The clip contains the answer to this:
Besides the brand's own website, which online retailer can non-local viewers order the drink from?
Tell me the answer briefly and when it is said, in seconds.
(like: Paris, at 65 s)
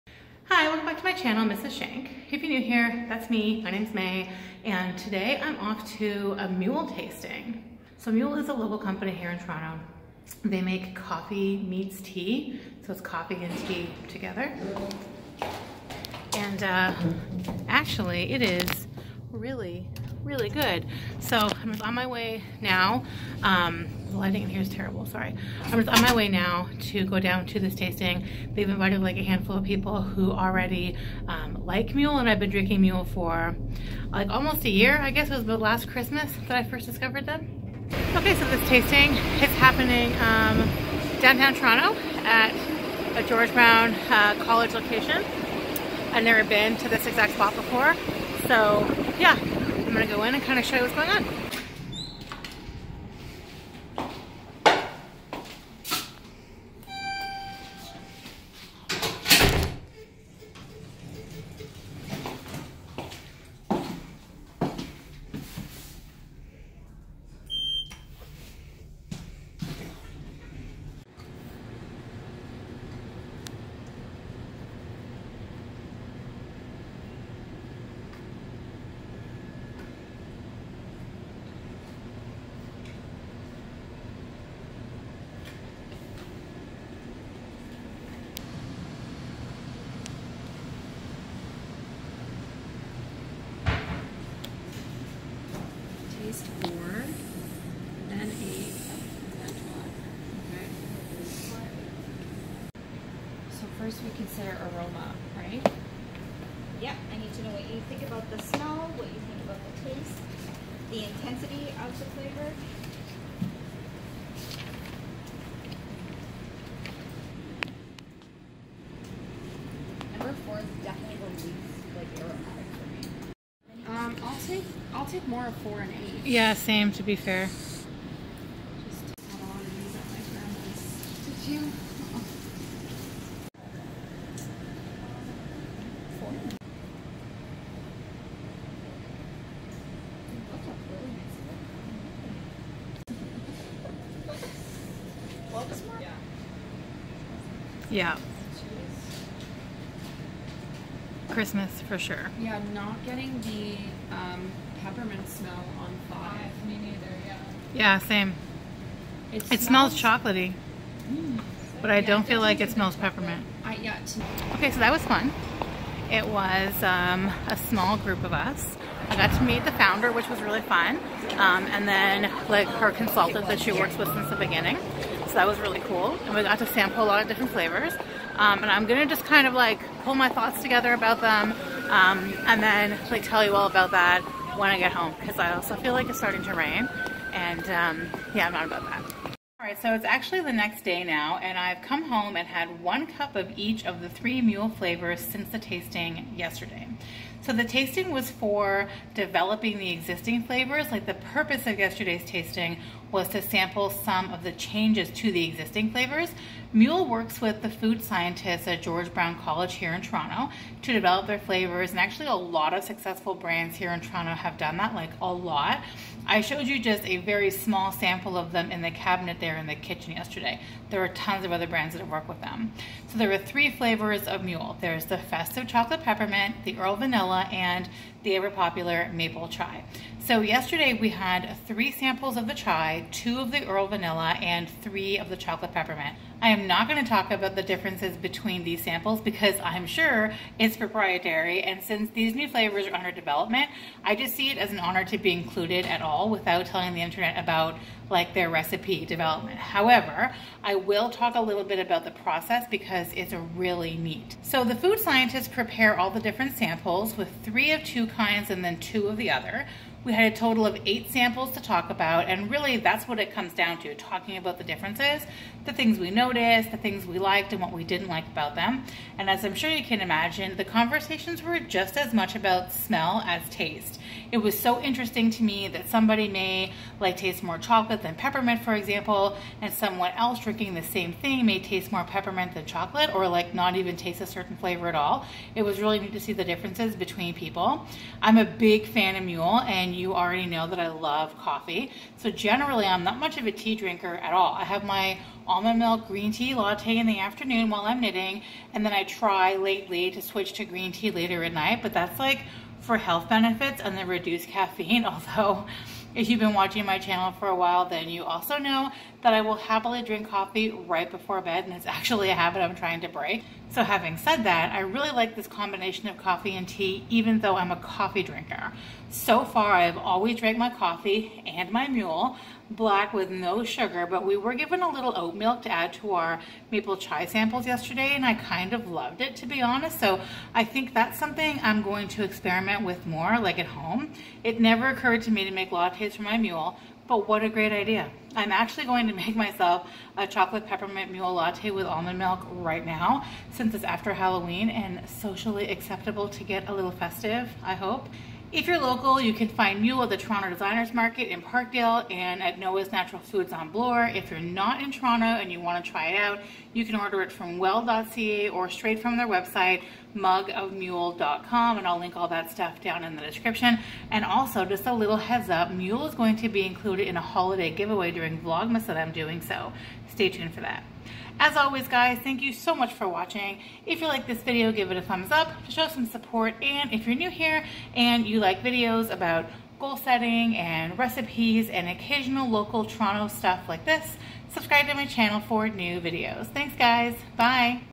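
well.ca, at 357 s.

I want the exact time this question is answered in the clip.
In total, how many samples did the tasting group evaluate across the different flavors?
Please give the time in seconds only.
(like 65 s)
260 s.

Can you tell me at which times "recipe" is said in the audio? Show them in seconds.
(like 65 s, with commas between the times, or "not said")
248 s, 380 s.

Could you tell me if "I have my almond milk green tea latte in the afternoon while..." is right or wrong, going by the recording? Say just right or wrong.
right.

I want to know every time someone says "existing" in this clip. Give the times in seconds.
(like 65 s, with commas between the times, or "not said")
199 s, 205 s.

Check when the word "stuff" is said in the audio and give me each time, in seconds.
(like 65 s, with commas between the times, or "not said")
362 s, 383 s.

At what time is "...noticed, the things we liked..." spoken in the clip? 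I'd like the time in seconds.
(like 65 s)
266 s.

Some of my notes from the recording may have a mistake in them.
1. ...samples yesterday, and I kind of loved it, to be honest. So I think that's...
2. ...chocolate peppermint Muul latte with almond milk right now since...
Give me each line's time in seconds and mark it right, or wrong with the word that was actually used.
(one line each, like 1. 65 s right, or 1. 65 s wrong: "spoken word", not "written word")
1. 327 s right
2. 340 s right.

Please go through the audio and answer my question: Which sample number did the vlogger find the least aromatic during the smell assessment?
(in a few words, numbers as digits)
4.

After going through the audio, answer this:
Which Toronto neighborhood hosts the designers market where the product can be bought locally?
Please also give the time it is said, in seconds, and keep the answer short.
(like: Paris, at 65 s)
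Parkdale, at 351 s.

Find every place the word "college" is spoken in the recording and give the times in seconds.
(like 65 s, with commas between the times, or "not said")
44 s, 209 s.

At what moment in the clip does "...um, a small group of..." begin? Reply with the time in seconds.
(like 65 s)
166 s.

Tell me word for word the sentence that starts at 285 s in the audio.
It was really neat to see the differences between people.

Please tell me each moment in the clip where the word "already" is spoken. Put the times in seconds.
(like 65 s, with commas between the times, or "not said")
30 s, 290 s.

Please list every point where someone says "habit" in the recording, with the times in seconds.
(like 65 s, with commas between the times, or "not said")
312 s.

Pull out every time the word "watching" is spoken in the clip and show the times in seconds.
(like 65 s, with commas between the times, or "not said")
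306 s, 373 s.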